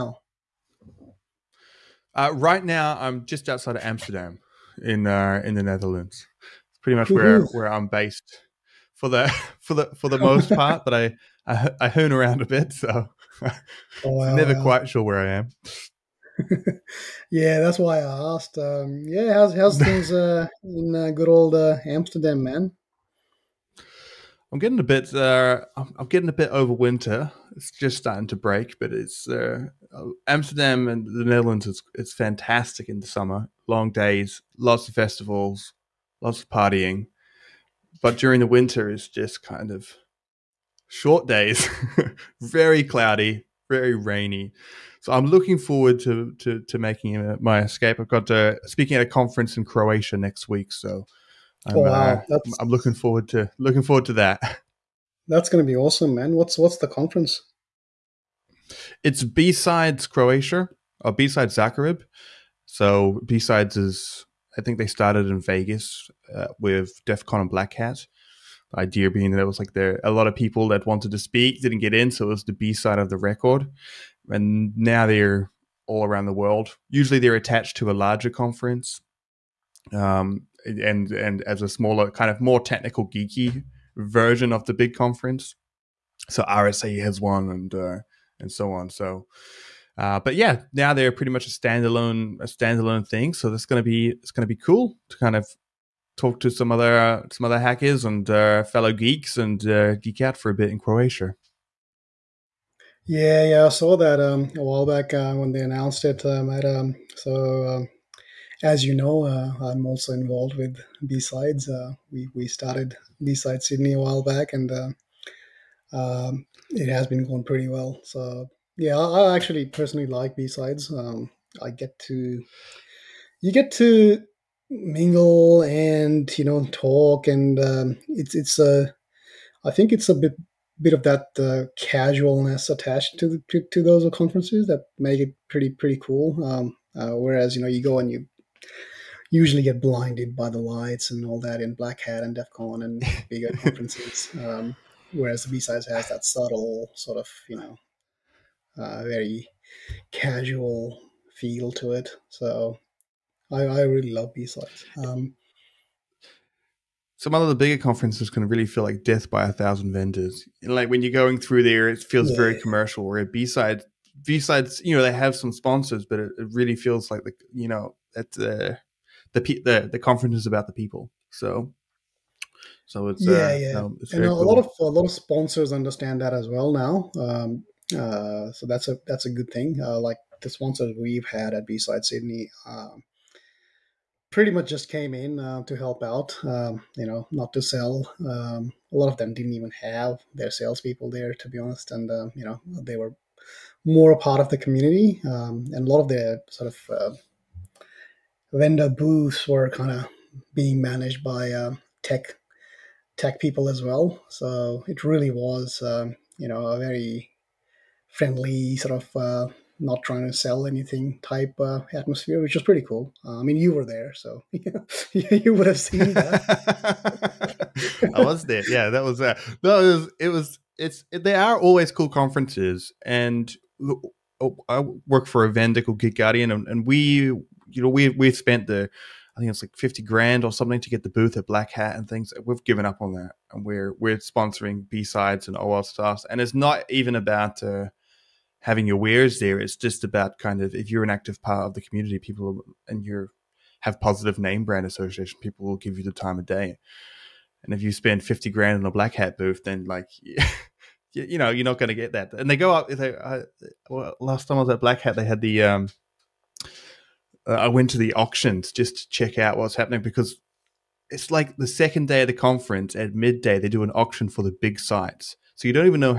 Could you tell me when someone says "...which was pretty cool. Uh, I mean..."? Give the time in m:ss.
3:32.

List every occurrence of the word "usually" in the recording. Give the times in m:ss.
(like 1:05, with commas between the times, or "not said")
1:16, 2:19.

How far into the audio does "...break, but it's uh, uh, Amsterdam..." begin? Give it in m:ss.
0:28.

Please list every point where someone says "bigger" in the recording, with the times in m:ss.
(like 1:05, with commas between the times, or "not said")
2:23, 2:37.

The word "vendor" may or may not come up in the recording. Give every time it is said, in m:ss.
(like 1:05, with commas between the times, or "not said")
2:39, 3:18, 3:45.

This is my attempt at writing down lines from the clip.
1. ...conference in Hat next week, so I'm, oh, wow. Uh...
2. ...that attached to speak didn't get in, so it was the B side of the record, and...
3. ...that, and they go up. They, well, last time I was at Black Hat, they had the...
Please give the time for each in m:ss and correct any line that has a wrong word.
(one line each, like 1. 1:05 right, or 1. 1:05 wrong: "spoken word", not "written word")
1. 0:49 wrong: "Croatia", not "Hat"
2. 1:10 wrong: "wanted", not "attached"
3. 4:12 right.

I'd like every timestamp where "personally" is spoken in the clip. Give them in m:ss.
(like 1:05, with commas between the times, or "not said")
1:59.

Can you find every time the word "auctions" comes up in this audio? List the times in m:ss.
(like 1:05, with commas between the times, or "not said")
4:18, 4:23.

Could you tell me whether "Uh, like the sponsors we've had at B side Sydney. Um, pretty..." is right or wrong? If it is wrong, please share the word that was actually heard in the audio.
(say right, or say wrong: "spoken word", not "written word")
right.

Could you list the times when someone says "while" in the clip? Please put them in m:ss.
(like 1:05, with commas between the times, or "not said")
1:44, 1:53.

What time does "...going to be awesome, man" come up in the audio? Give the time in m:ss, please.
0:55.